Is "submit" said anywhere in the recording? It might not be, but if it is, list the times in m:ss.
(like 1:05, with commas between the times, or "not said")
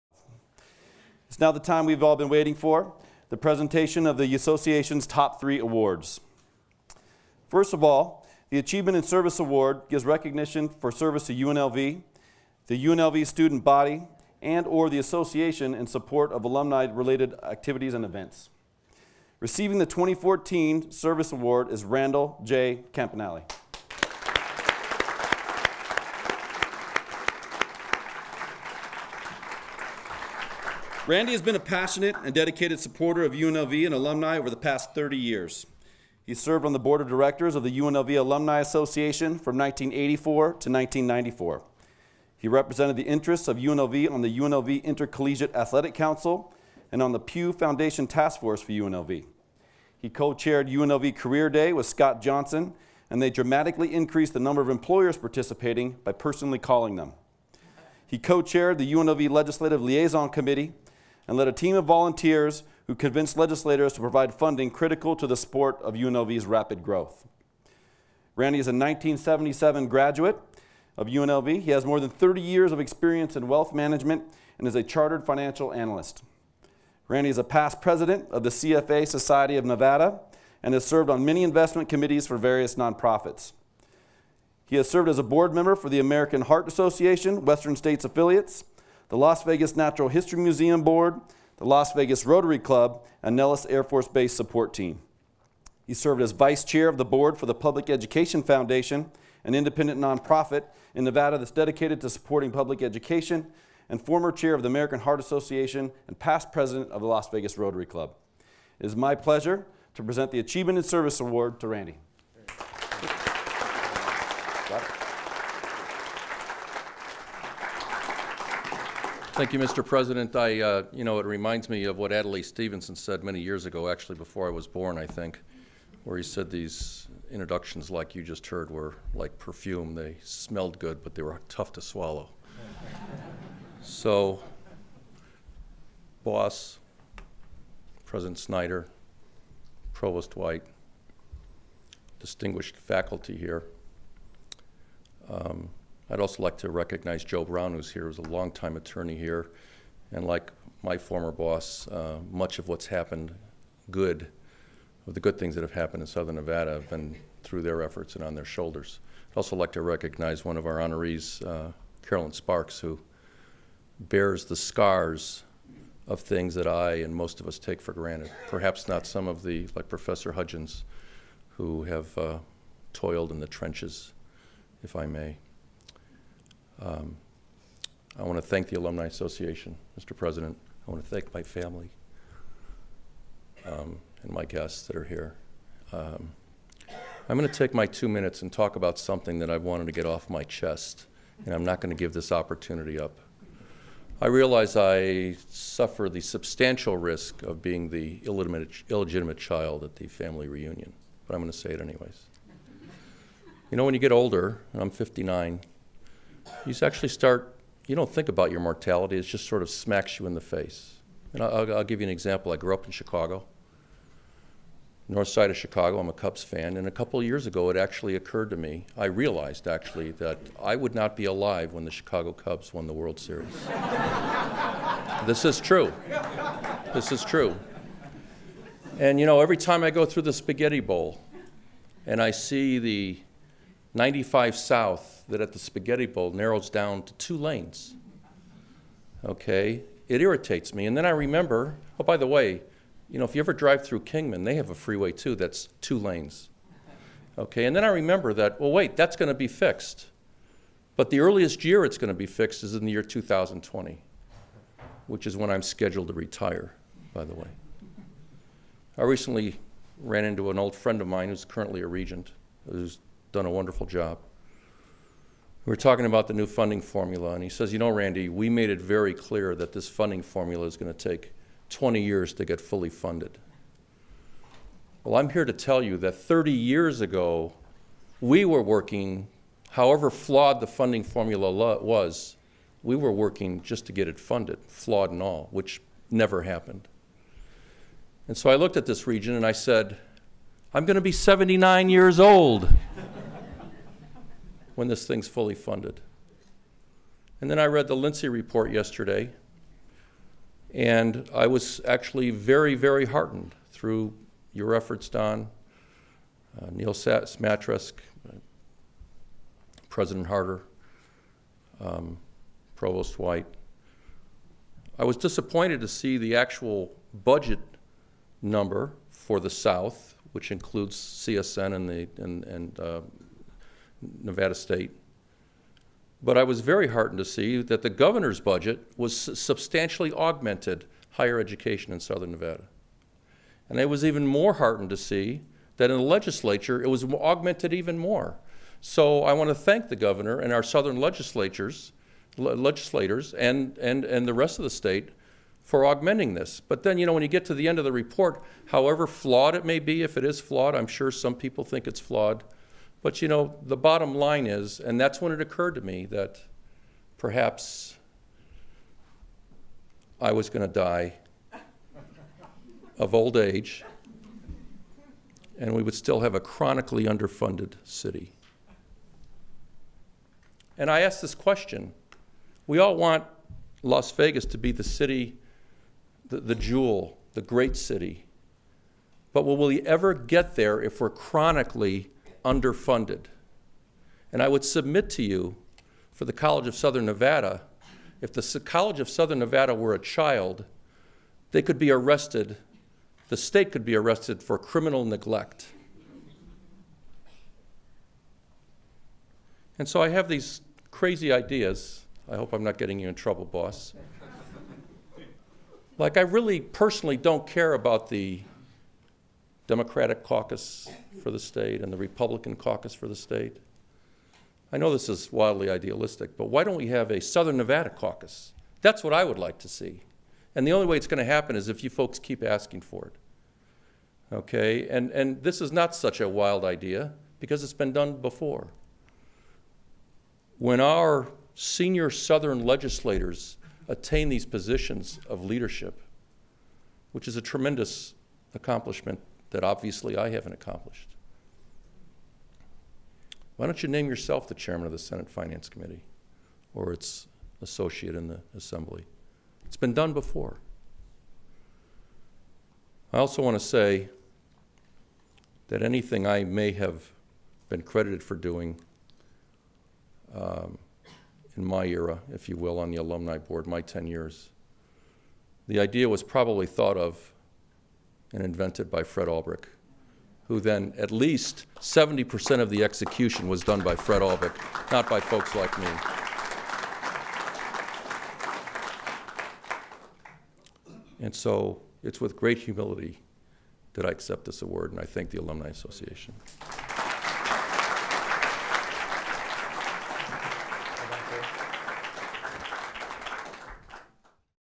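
6:24.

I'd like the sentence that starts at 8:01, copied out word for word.
And so it's with great humility that I accept this award, and I thank the Alumni Association.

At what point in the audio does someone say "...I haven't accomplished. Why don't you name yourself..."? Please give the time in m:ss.
7:20.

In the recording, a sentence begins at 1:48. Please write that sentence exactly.
It is my pleasure to present the Achievement and Service Award to Randy.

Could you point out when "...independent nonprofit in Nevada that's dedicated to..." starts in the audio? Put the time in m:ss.
1:39.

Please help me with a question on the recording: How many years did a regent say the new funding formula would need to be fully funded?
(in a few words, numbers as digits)
20 years.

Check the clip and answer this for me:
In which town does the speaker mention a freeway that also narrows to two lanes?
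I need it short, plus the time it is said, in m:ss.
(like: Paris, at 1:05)
Kingman, at 4:04.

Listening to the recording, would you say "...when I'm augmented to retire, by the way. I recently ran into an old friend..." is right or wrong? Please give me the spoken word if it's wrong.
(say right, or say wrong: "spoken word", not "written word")
wrong: "scheduled", not "augmented".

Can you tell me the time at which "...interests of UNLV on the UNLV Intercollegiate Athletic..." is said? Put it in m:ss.
0:43.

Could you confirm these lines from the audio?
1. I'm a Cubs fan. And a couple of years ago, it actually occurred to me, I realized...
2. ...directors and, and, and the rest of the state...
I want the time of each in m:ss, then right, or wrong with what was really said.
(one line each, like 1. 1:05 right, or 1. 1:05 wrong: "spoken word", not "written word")
1. 3:35 right
2. 5:42 wrong: "legislators", not "directors".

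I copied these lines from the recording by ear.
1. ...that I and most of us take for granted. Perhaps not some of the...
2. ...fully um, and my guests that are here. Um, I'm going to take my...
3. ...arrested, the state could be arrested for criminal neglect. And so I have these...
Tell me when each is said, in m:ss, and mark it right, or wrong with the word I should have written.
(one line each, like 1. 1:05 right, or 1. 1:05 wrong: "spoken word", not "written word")
1. 2:46 right
2. 3:01 wrong: "family", not "fully"
3. 6:31 right.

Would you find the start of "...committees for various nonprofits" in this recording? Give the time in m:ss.
1:21.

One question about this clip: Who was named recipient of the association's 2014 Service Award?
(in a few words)
Randall J. Campanale.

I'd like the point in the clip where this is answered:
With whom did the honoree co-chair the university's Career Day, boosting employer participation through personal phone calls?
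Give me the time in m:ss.
0:51.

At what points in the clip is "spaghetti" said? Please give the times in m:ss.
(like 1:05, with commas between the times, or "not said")
3:50, 3:55.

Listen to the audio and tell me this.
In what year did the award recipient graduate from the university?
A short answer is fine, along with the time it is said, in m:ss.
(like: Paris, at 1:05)
1977, at 1:08.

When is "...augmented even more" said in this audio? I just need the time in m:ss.
5:37.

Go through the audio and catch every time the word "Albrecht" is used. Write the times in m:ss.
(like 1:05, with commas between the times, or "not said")
7:49, 7:54.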